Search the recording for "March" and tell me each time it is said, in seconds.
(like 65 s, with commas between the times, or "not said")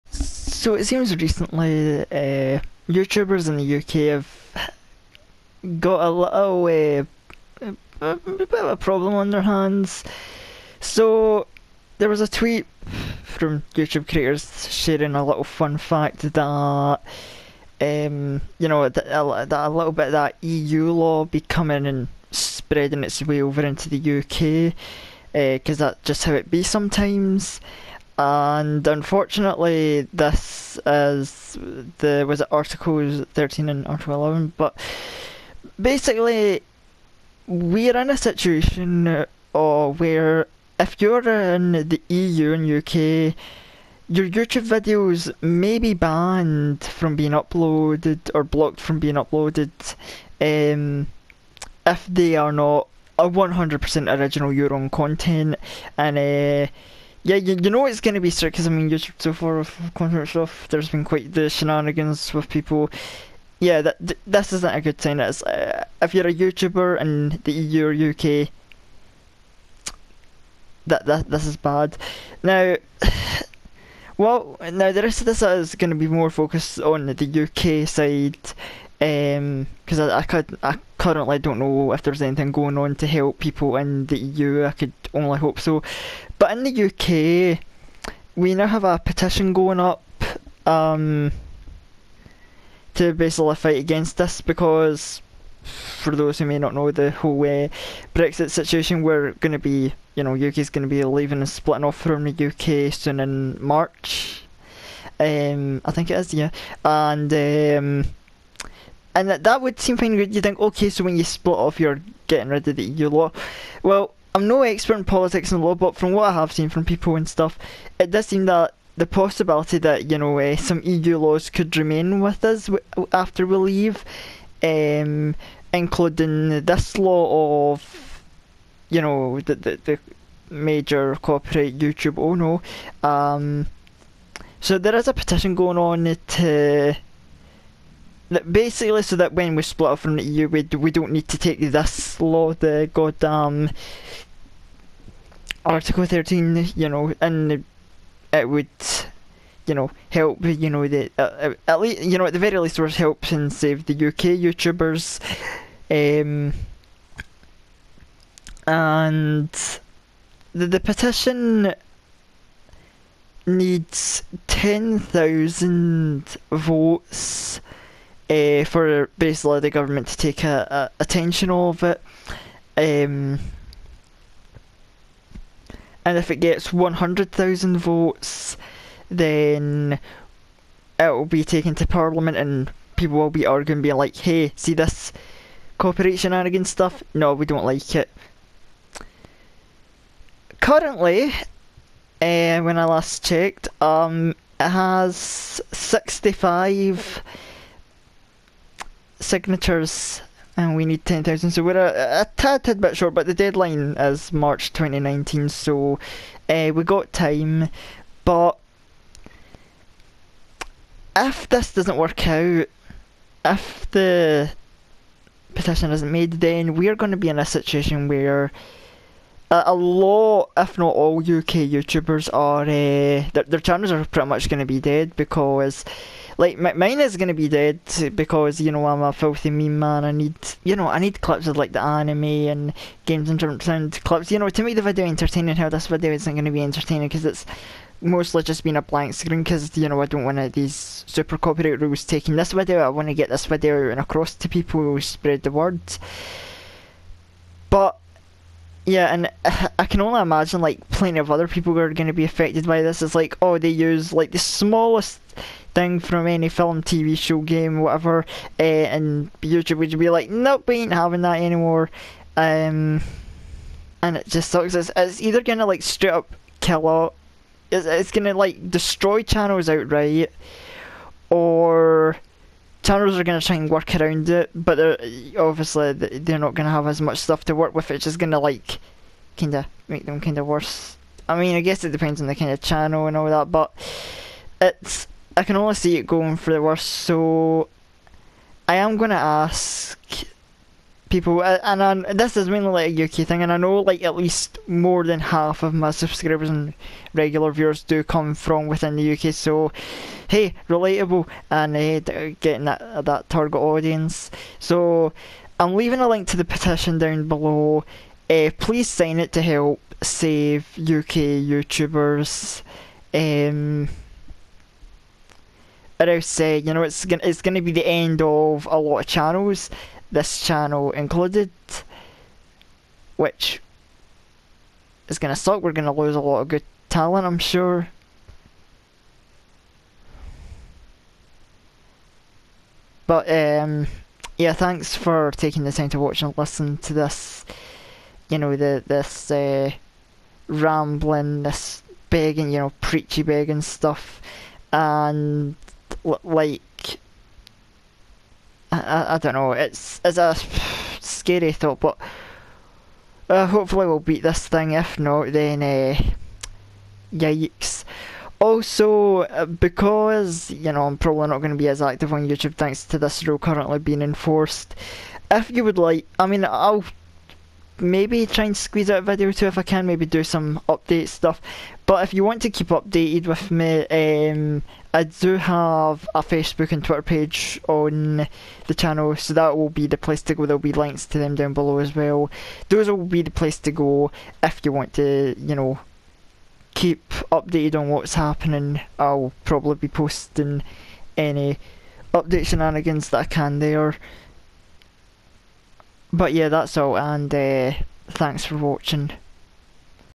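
103 s, 204 s.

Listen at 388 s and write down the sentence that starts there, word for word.
I'll probably be posting any update shenanigans that I can there.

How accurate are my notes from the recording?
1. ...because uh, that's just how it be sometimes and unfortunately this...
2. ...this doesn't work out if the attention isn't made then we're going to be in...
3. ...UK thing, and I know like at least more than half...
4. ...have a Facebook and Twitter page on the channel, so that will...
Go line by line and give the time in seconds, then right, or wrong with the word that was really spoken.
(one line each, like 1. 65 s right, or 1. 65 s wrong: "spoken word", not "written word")
1. 25 s right
2. 211 s wrong: "petition", not "attention"
3. 293 s right
4. 375 s right.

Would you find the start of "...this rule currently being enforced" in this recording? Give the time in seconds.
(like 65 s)
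362 s.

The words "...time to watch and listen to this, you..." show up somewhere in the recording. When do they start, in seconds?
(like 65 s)
335 s.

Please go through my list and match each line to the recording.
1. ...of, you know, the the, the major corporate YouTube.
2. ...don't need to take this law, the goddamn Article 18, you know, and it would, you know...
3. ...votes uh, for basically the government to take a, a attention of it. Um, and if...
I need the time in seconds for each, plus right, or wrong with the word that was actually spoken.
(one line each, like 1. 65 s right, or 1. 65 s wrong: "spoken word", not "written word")
1. 127 s right
2. 140 s wrong: "13", not "18"
3. 166 s right.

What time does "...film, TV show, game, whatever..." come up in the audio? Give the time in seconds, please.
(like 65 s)
256 s.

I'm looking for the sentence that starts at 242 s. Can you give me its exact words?
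I want to get this video and across to people, spread the word.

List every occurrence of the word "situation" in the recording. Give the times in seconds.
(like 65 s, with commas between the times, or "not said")
38 s, 98 s, 217 s.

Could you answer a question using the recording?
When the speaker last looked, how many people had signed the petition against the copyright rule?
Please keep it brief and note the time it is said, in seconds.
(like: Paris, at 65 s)
65, at 195 s.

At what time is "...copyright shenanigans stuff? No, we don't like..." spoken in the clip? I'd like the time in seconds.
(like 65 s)
185 s.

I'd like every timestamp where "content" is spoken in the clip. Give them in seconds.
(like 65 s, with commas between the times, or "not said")
54 s, 59 s.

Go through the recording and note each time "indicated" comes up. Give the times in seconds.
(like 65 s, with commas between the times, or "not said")
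not said.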